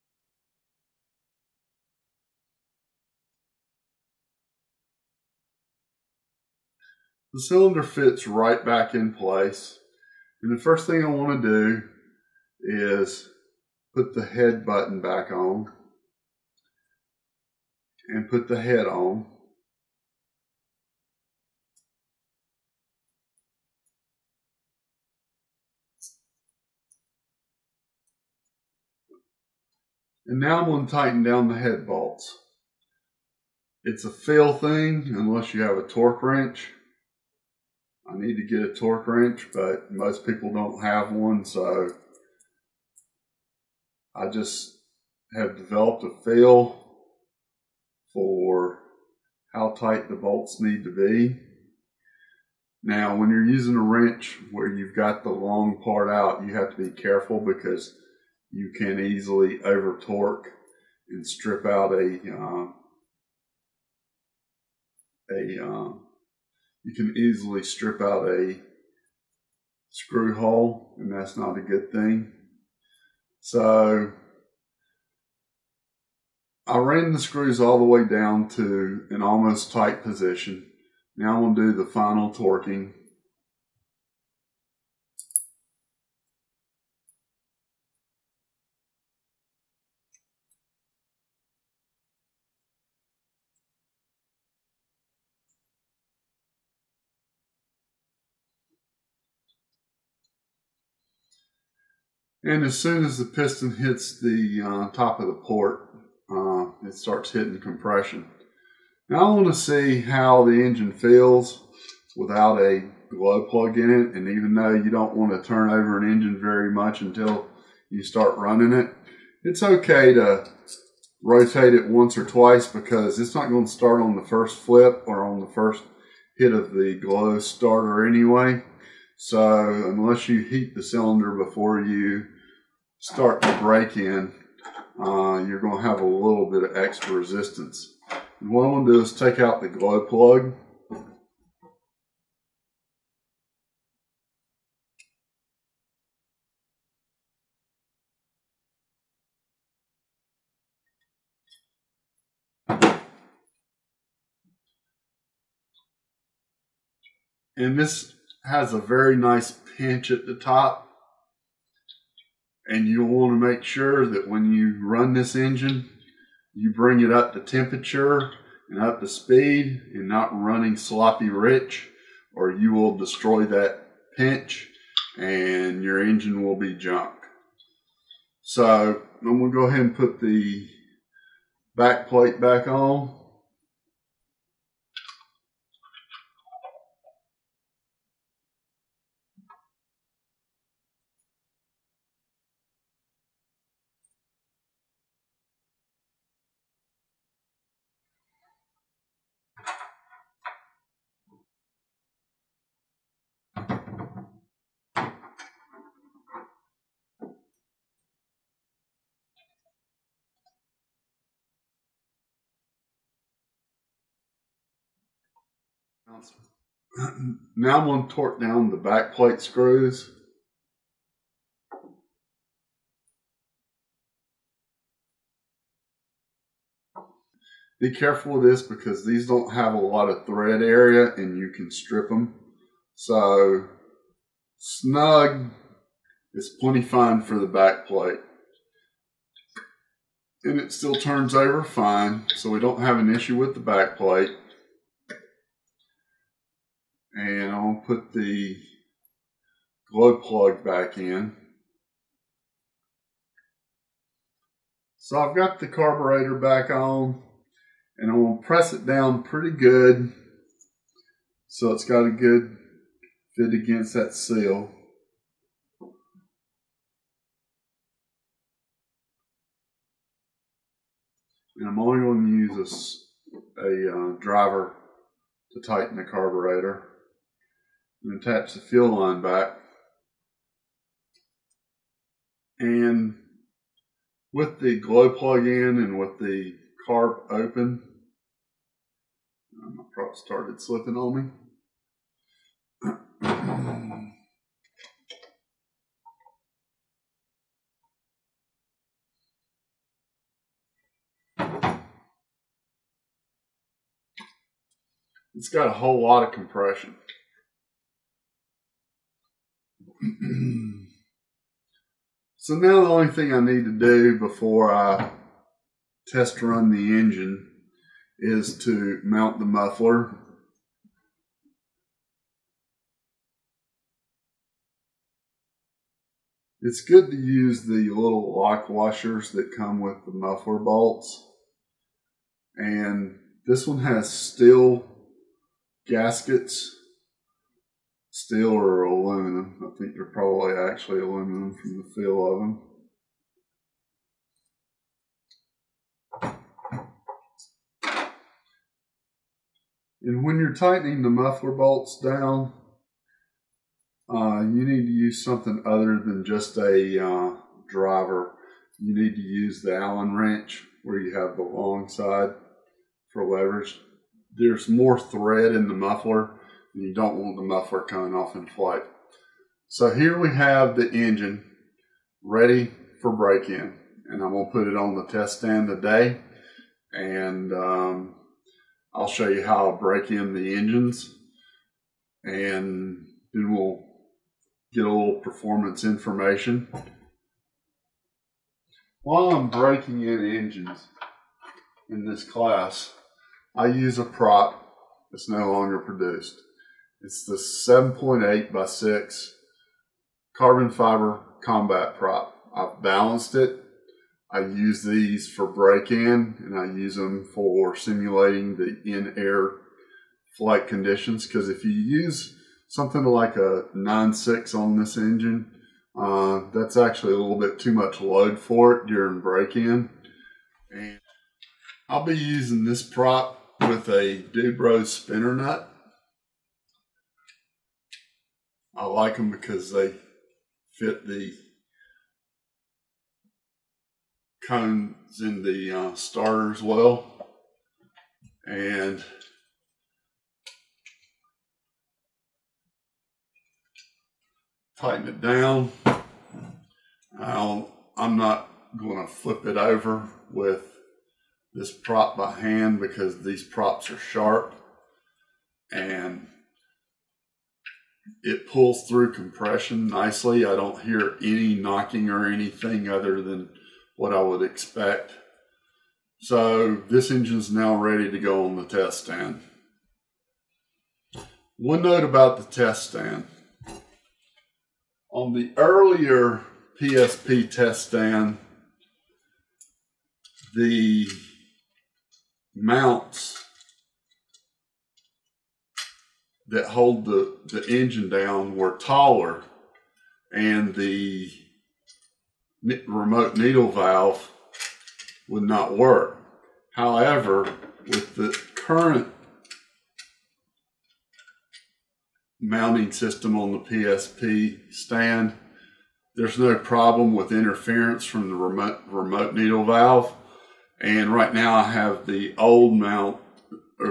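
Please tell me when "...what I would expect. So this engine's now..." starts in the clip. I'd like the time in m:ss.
7:43.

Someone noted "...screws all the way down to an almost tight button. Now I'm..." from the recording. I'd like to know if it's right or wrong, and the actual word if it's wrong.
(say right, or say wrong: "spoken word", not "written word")
wrong: "position", not "button".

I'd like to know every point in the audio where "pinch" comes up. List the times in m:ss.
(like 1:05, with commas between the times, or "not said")
2:39, 2:54.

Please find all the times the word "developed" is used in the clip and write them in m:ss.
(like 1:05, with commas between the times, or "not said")
0:45.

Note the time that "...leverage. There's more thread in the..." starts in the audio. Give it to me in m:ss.
6:03.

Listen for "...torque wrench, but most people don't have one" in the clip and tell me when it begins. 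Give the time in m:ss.
0:38.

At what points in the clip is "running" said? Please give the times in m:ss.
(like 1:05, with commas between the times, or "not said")
1:58, 2:50.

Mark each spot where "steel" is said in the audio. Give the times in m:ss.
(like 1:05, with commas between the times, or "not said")
5:34, 5:38.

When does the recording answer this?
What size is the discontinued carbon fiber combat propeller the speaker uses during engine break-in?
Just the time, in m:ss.
6:37.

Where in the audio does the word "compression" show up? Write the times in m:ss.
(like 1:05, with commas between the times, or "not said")
1:47, 5:06, 7:39.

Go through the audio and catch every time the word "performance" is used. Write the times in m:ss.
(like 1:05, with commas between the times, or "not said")
6:25.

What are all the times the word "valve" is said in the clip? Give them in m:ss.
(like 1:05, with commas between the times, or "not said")
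8:13, 8:29.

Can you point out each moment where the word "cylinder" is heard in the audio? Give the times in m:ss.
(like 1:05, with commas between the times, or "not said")
0:07, 2:10.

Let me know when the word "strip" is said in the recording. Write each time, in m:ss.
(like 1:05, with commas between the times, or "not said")
1:01, 1:07, 3:51.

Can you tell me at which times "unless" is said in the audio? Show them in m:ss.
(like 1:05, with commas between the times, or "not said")
0:35, 2:09.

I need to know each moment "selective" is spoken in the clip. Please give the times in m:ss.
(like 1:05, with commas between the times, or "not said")
not said.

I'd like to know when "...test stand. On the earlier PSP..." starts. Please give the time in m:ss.
7:52.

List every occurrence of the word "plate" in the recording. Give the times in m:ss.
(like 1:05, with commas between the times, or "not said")
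3:02, 3:39, 3:57, 4:03.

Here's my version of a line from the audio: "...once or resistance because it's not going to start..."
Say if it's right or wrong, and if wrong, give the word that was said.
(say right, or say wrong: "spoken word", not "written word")
wrong: "twice", not "resistance".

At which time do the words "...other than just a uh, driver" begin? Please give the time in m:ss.
5:55.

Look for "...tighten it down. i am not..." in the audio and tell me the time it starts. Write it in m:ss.
7:24.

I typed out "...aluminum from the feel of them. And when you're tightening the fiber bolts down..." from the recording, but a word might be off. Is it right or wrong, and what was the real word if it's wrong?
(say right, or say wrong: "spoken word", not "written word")
wrong: "muffler", not "fiber".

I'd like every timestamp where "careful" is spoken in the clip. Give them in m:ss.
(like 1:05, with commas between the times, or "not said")
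0:56, 3:47.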